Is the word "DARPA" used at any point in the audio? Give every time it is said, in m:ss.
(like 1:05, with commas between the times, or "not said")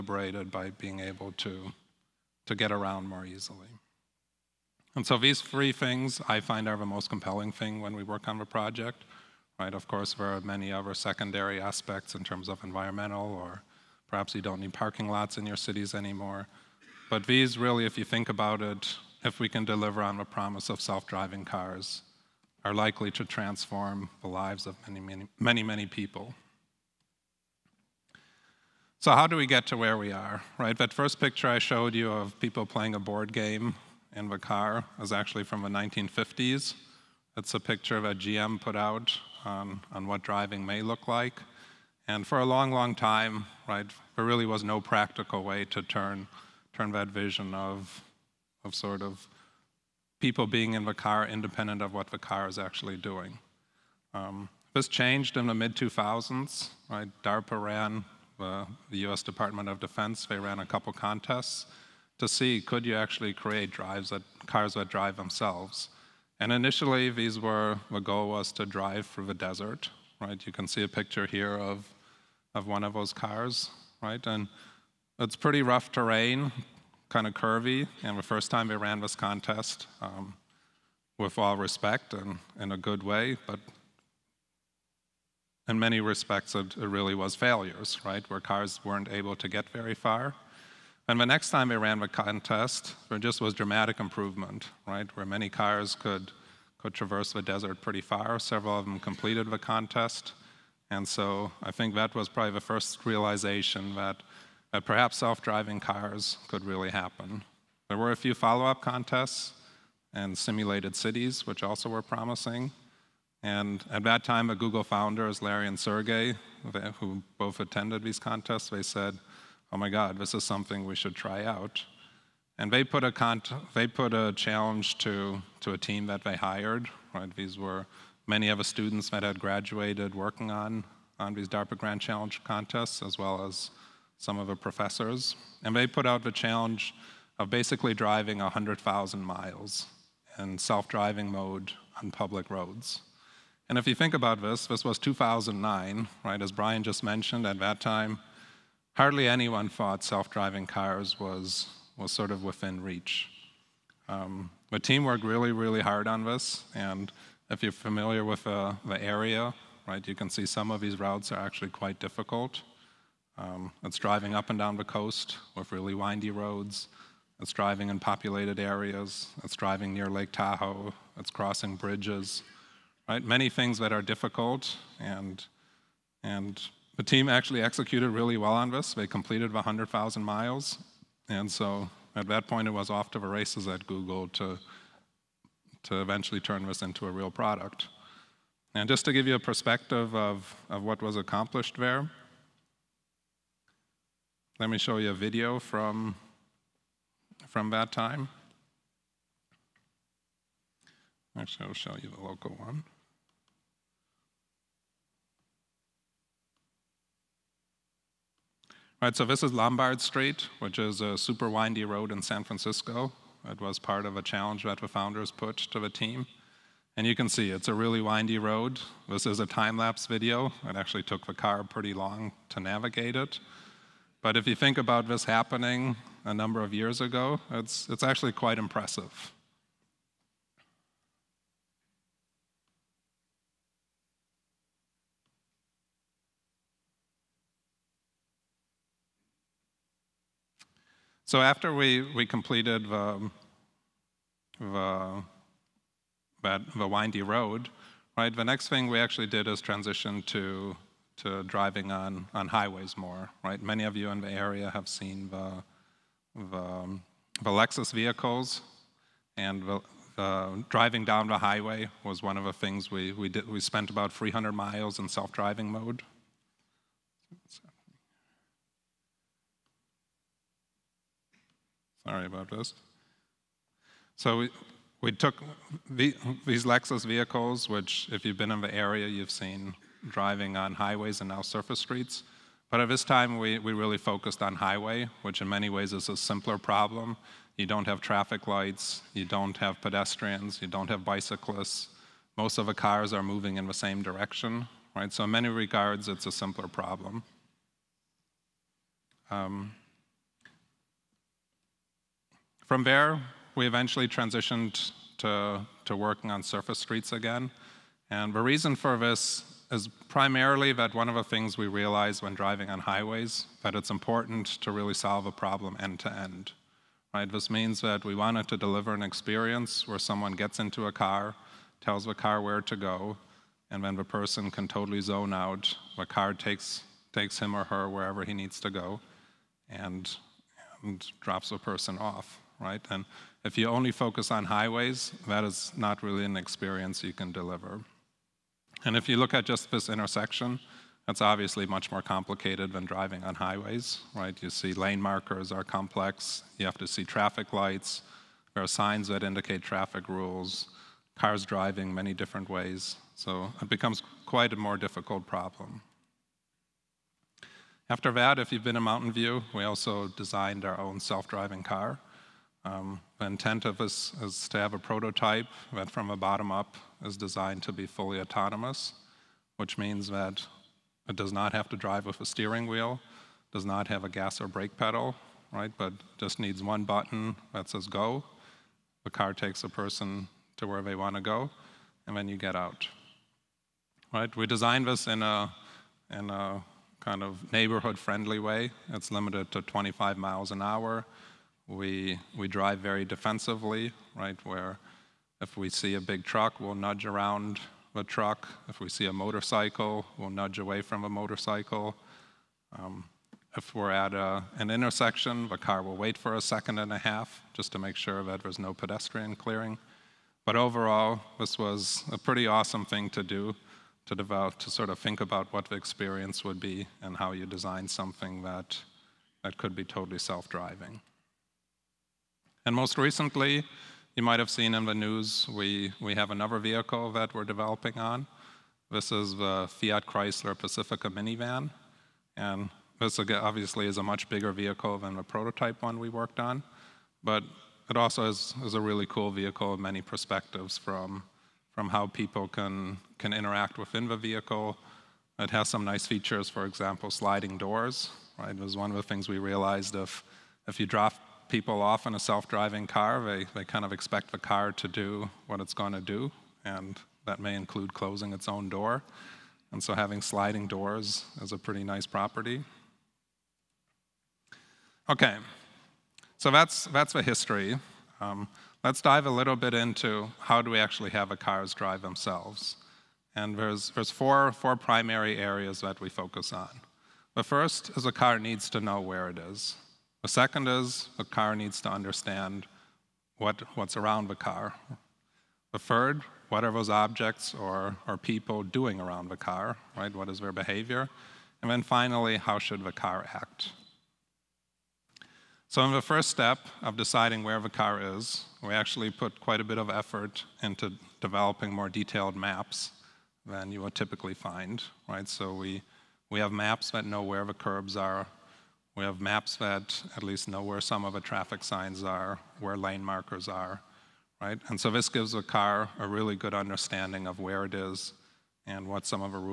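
0:57, 2:11.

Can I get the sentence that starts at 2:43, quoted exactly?
Um, it's driving up and down the coast with really windy roads.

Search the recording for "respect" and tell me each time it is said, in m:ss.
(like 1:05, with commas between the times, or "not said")
1:21, 1:25.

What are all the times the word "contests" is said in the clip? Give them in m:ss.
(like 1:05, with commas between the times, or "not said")
1:00, 1:19, 1:32, 1:39, 1:48, 1:58, 2:12.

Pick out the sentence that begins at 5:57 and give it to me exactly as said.
After that, if you've been in Mountain View, we also designed our own self-driving car.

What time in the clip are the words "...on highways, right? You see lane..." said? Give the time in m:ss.
5:43.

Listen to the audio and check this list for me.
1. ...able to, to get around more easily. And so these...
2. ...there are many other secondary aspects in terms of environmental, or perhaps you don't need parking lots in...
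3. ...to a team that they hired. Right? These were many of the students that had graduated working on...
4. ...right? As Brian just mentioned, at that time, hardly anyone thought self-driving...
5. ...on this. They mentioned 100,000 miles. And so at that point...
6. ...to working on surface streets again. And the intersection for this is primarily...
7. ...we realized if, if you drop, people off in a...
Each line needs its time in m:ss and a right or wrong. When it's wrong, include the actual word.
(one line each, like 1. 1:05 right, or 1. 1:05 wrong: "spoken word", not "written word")
1. 0:00 right
2. 0:10 right
3. 2:05 right
4. 2:26 right
5. 2:58 wrong: "completed", not "mentioned"
6. 5:05 wrong: "reason", not "intersection"
7. 7:29 right.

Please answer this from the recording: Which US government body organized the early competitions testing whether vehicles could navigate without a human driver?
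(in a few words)
US Department of Defense.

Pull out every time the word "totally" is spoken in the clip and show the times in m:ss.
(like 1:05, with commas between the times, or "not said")
5:24, 6:59.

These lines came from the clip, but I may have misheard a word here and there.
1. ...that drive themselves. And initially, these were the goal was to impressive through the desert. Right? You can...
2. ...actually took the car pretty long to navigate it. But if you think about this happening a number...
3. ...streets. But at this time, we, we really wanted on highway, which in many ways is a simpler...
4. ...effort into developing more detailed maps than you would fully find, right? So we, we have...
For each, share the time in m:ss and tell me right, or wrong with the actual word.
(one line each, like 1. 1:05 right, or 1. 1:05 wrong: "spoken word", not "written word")
1. 1:04 wrong: "drive", not "impressive"
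2. 3:40 right
3. 4:41 wrong: "focused", not "wanted"
4. 8:19 wrong: "typically", not "fully".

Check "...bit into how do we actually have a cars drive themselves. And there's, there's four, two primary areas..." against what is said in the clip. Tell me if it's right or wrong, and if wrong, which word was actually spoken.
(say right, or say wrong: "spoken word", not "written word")
wrong: "four", not "two".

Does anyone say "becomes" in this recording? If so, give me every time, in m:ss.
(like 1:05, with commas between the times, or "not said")
5:53.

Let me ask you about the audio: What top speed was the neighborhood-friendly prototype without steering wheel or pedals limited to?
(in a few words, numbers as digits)
25 miles an hour.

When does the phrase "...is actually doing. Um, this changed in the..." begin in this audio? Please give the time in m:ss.
0:52.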